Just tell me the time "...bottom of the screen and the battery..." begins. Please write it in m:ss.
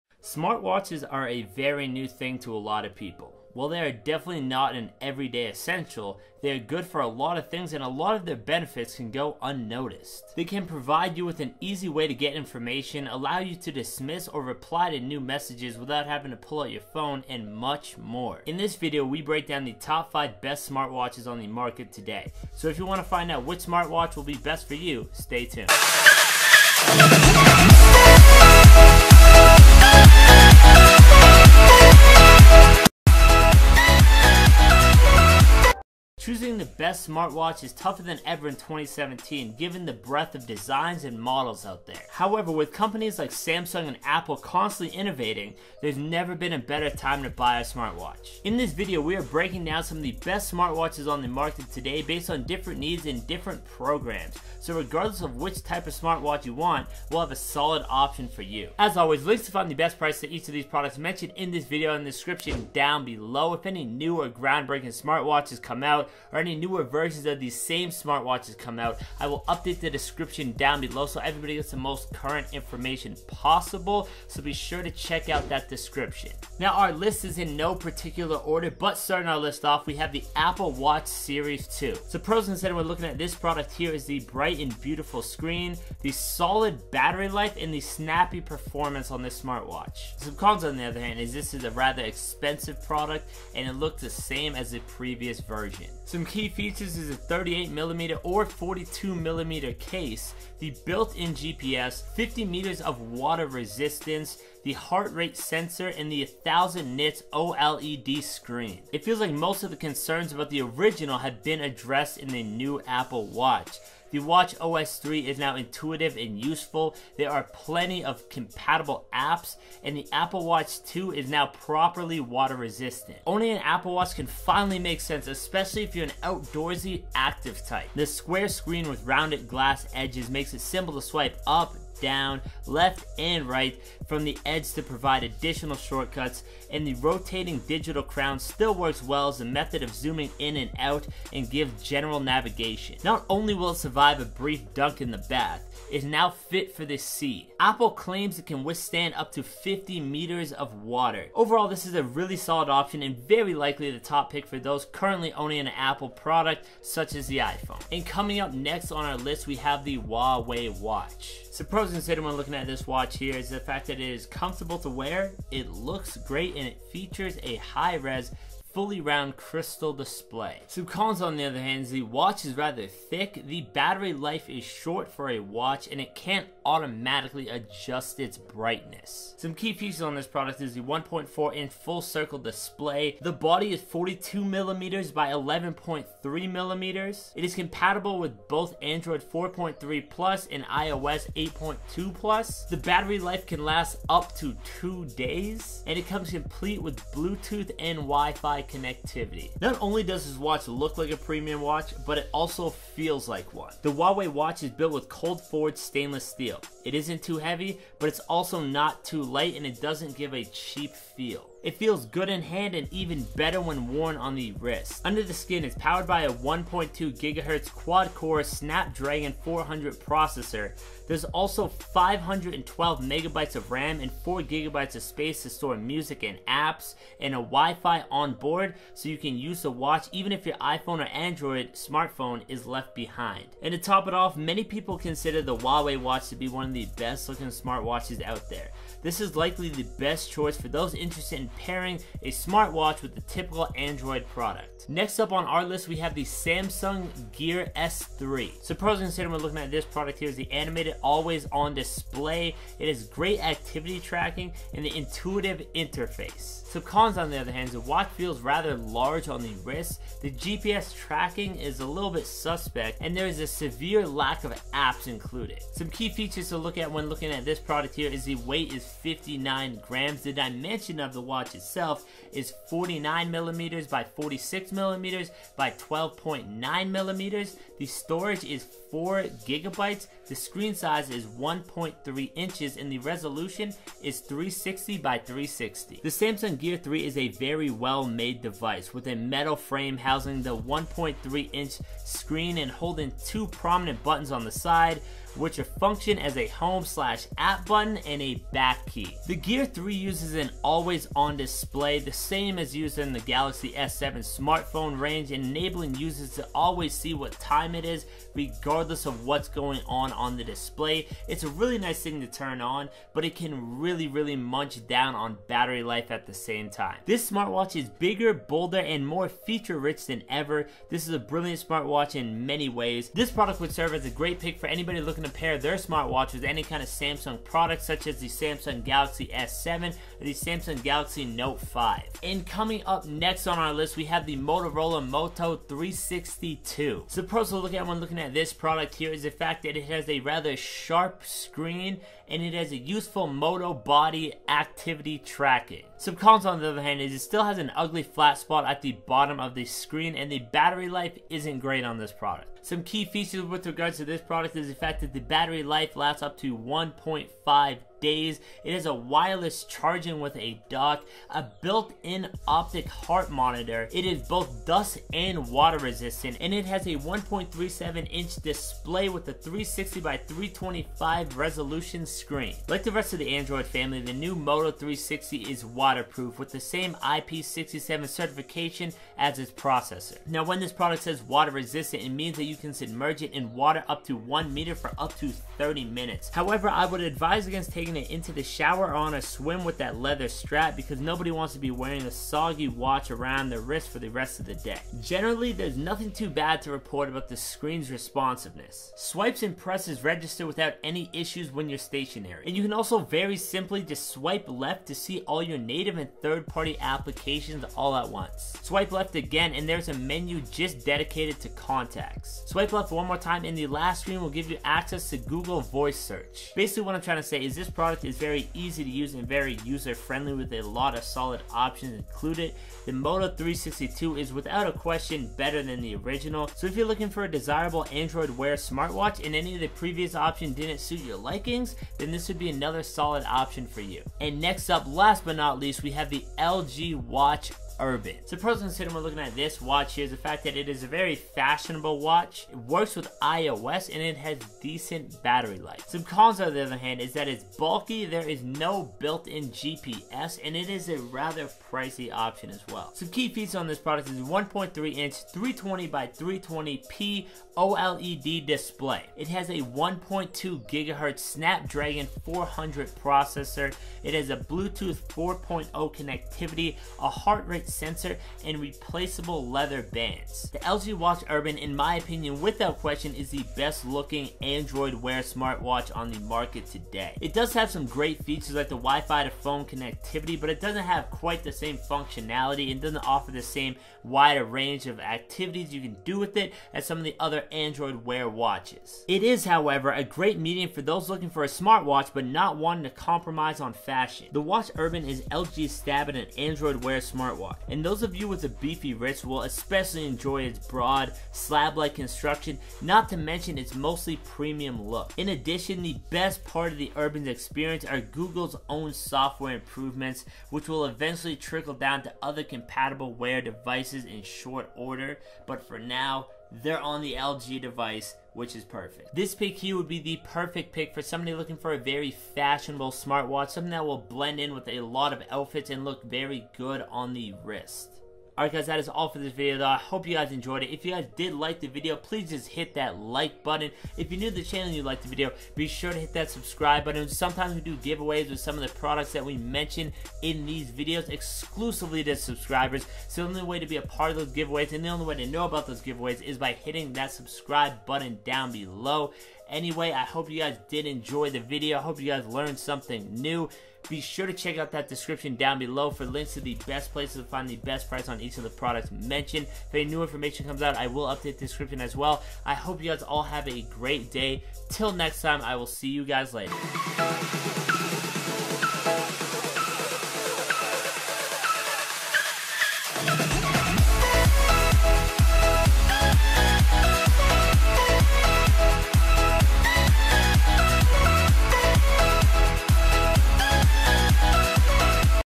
5:49.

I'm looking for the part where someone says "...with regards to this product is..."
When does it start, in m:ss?
5:53.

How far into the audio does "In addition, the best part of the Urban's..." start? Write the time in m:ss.
8:25.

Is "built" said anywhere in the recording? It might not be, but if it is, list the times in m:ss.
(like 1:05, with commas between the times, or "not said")
1:40, 3:24, 6:01, 7:28.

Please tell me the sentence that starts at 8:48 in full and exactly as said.
Alright guys, that is all for this video though.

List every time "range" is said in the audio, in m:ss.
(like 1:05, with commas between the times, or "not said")
5:04, 8:04.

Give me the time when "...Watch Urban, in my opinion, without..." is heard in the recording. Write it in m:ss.
7:50.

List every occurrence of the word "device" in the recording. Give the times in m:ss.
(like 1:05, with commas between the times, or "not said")
4:48, 8:33, 8:37.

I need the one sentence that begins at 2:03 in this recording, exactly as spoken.
Only an Apple Watch can finally make sense, especially if you're an outdoorsy active type.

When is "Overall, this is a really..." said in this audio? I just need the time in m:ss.
2:31.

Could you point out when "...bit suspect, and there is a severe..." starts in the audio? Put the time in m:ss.
4:22.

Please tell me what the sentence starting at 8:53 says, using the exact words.
If you're new to the channel and you like the video, be sure to hit that subscribe button.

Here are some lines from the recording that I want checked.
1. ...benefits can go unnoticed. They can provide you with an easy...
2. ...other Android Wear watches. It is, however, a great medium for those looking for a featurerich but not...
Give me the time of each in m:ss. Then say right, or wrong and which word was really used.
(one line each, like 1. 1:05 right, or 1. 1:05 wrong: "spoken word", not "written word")
1. 0:08 right
2. 8:07 wrong: "smartwatch", not "featurerich".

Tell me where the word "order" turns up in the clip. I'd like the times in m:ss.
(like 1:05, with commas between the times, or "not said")
1:18, 8:34.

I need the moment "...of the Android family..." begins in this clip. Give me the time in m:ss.
6:13.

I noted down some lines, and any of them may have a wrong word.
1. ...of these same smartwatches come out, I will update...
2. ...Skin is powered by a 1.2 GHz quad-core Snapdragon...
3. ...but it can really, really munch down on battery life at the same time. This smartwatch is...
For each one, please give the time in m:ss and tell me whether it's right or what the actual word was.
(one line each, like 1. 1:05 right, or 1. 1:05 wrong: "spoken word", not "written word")
1. 1:07 right
2. 3:35 right
3. 5:13 right.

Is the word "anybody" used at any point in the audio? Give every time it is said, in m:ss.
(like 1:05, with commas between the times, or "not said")
5:24.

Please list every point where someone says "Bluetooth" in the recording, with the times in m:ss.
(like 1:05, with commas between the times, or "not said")
3:17, 7:44.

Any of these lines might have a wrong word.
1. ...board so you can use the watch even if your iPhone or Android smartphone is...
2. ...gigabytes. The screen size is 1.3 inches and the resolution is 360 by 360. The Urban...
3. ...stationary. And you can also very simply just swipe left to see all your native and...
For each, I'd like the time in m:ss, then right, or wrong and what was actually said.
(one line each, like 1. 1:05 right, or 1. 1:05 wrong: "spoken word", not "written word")
1. 3:48 right
2. 4:39 wrong: "Samsung", not "Urban"
3. 6:41 right.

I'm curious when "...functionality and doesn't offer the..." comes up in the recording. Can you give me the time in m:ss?
8:01.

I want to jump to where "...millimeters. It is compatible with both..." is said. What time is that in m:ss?
3:06.